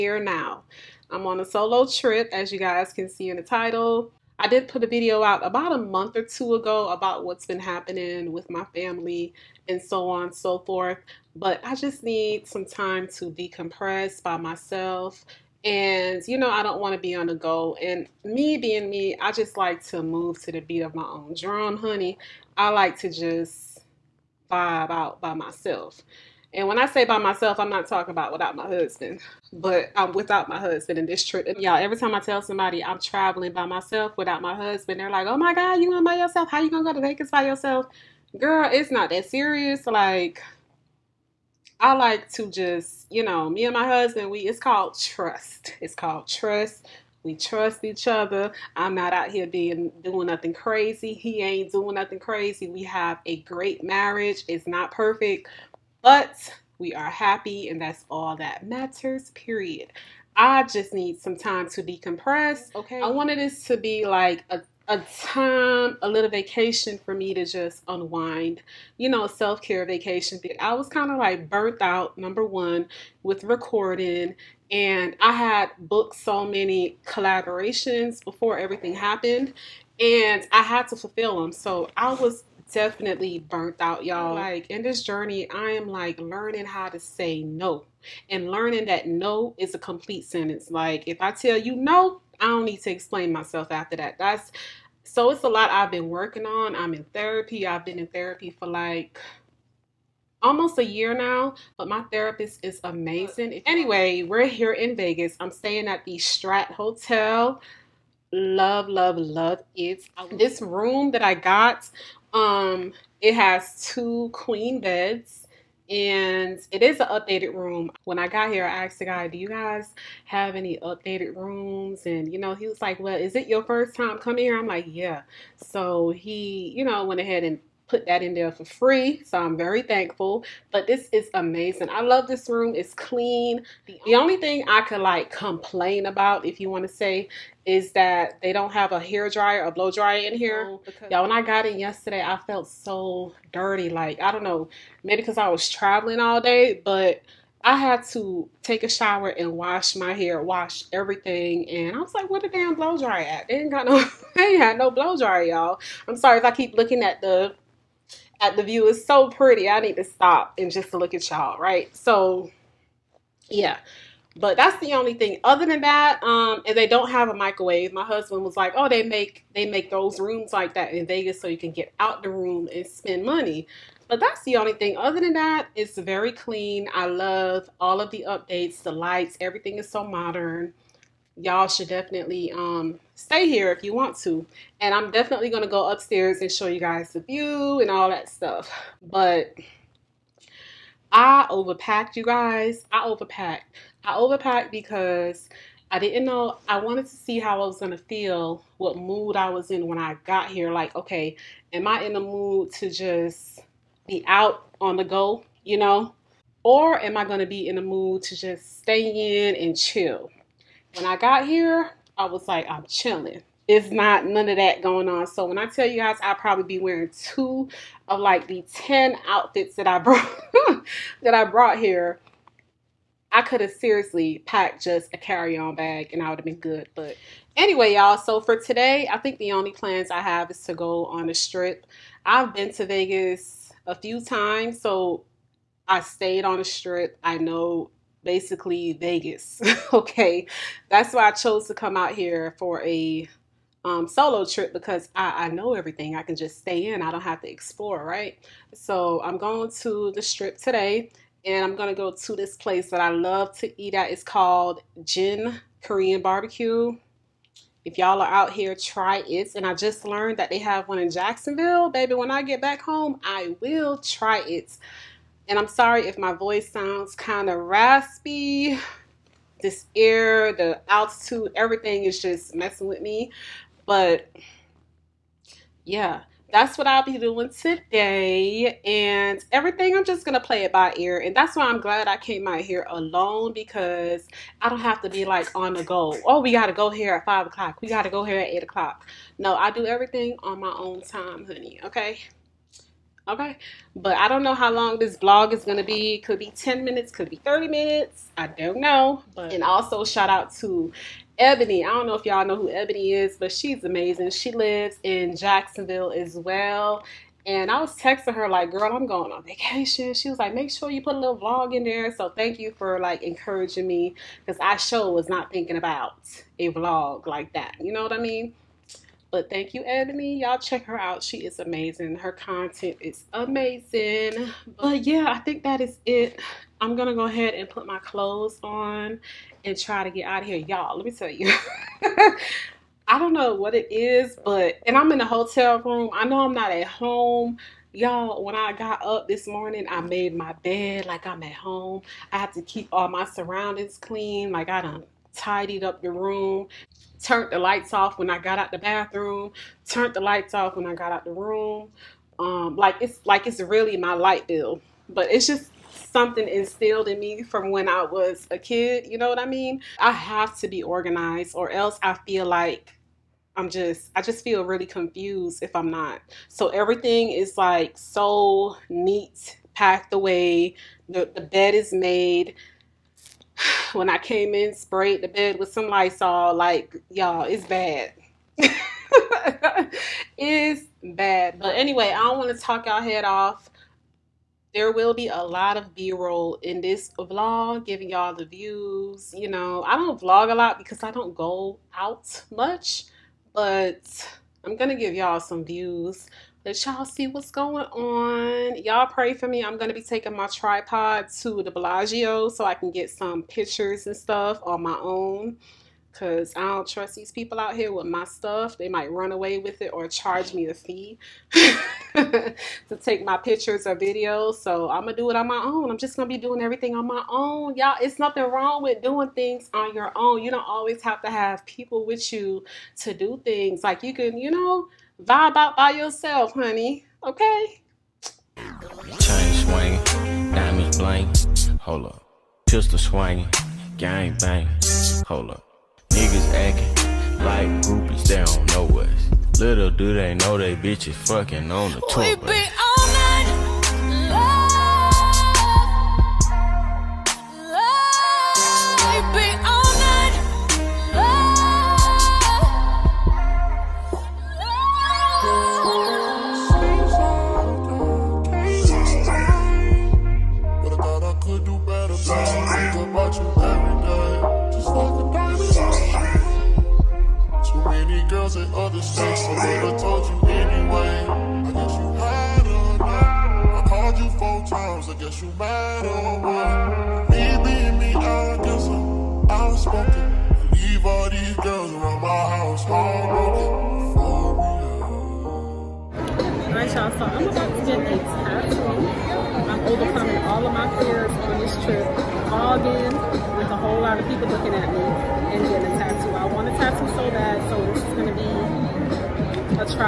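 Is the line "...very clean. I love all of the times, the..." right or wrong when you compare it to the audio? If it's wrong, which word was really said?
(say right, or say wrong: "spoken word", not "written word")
wrong: "updates", not "times".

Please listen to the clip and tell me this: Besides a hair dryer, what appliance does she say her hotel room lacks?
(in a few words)
microwave.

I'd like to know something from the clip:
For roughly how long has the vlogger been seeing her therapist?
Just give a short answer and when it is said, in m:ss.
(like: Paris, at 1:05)
almost a year, at 1:40.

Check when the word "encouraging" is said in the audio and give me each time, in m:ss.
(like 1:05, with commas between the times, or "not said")
5:13.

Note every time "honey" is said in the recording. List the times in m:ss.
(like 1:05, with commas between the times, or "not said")
0:21, 4:51, 7:06.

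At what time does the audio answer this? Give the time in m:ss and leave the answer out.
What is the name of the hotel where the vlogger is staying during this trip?
1:46.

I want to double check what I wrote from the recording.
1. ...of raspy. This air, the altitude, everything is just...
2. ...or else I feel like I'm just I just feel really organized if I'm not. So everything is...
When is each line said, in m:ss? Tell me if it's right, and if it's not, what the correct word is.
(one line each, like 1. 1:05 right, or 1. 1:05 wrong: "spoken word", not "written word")
1. 4:27 right
2. 6:01 wrong: "confused", not "organized".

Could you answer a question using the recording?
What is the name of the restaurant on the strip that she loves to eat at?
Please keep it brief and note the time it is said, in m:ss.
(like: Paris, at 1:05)
Gen Korean Barbecue, at 4:15.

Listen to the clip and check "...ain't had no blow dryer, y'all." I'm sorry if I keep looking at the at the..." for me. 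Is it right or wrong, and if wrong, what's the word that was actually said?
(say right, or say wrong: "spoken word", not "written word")
right.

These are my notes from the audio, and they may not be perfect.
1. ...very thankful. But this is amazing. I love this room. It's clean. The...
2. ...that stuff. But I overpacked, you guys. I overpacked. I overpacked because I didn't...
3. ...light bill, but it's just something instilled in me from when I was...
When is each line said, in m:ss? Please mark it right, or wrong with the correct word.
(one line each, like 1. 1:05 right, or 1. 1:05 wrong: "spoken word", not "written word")
1. 2:09 right
2. 3:08 right
3. 5:54 right.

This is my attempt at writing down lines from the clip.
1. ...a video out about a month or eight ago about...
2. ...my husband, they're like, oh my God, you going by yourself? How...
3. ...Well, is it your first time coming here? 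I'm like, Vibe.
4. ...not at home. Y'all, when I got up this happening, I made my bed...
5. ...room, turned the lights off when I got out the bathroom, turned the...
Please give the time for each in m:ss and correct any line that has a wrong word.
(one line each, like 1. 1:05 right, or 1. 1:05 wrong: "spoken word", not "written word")
1. 0:04 wrong: "two", not "eight"
2. 0:34 right
3. 2:02 wrong: "Yeah", not "Vibe"
4. 5:36 wrong: "morning", not "happening"
5. 5:46 right.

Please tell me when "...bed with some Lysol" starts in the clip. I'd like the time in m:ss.
6:15.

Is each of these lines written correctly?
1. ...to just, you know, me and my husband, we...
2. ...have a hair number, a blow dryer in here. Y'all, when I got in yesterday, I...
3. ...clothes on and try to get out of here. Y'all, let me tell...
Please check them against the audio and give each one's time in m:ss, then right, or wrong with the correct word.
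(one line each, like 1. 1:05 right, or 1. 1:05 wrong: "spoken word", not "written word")
1. 0:42 right
2. 2:18 wrong: "dryer", not "number"
3. 5:27 right.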